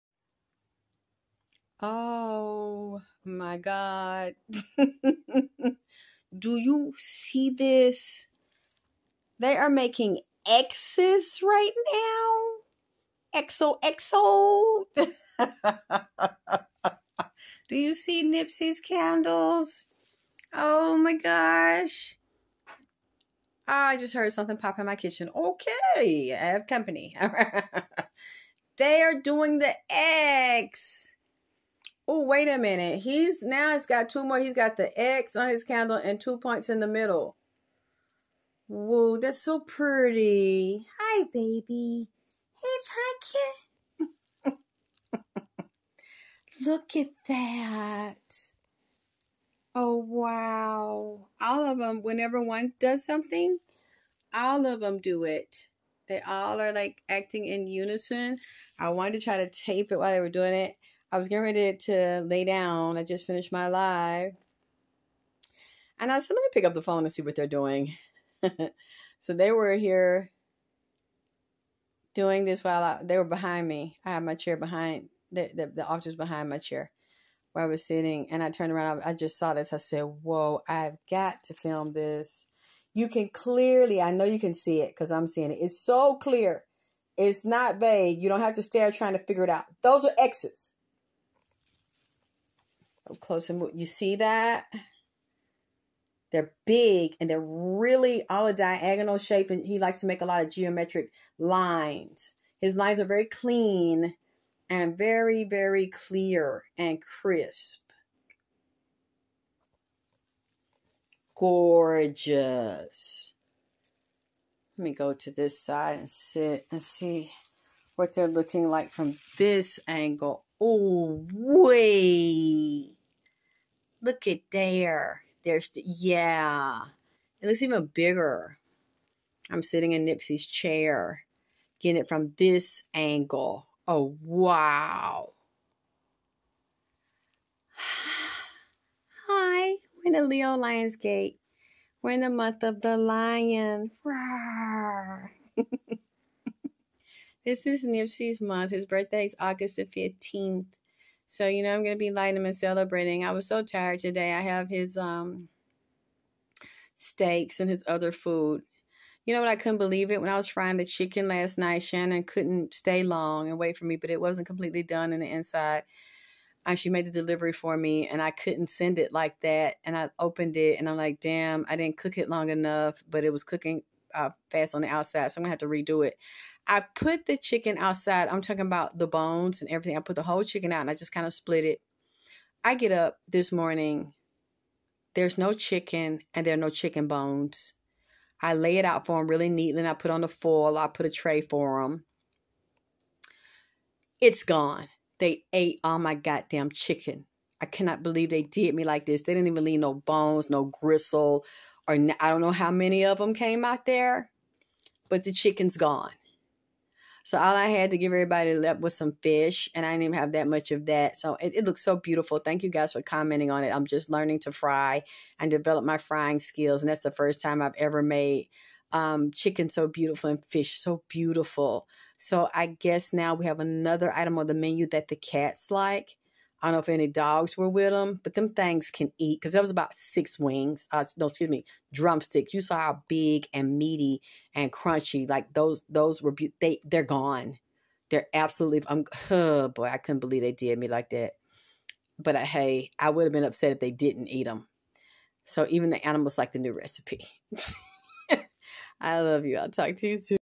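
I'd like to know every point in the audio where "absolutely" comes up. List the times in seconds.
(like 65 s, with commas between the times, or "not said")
238 s.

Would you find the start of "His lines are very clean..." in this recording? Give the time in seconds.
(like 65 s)
102 s.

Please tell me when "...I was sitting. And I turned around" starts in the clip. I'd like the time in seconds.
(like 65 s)
77 s.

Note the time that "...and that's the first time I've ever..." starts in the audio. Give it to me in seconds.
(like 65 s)
216 s.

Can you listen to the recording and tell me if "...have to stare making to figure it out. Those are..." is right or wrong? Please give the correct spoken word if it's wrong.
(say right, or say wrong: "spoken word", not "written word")
wrong: "trying", not "making".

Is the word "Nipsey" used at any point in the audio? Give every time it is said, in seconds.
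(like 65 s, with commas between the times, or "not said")
18 s, 130 s, 147 s.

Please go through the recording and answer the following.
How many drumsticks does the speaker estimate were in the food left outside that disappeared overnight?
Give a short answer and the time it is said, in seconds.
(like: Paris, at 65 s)
6, at 229 s.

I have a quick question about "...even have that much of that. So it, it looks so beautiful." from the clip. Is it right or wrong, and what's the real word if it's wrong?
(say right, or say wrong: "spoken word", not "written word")
right.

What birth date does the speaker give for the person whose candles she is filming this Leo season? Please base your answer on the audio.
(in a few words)
August 15.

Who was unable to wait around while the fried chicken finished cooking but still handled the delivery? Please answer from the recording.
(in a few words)
Shannon.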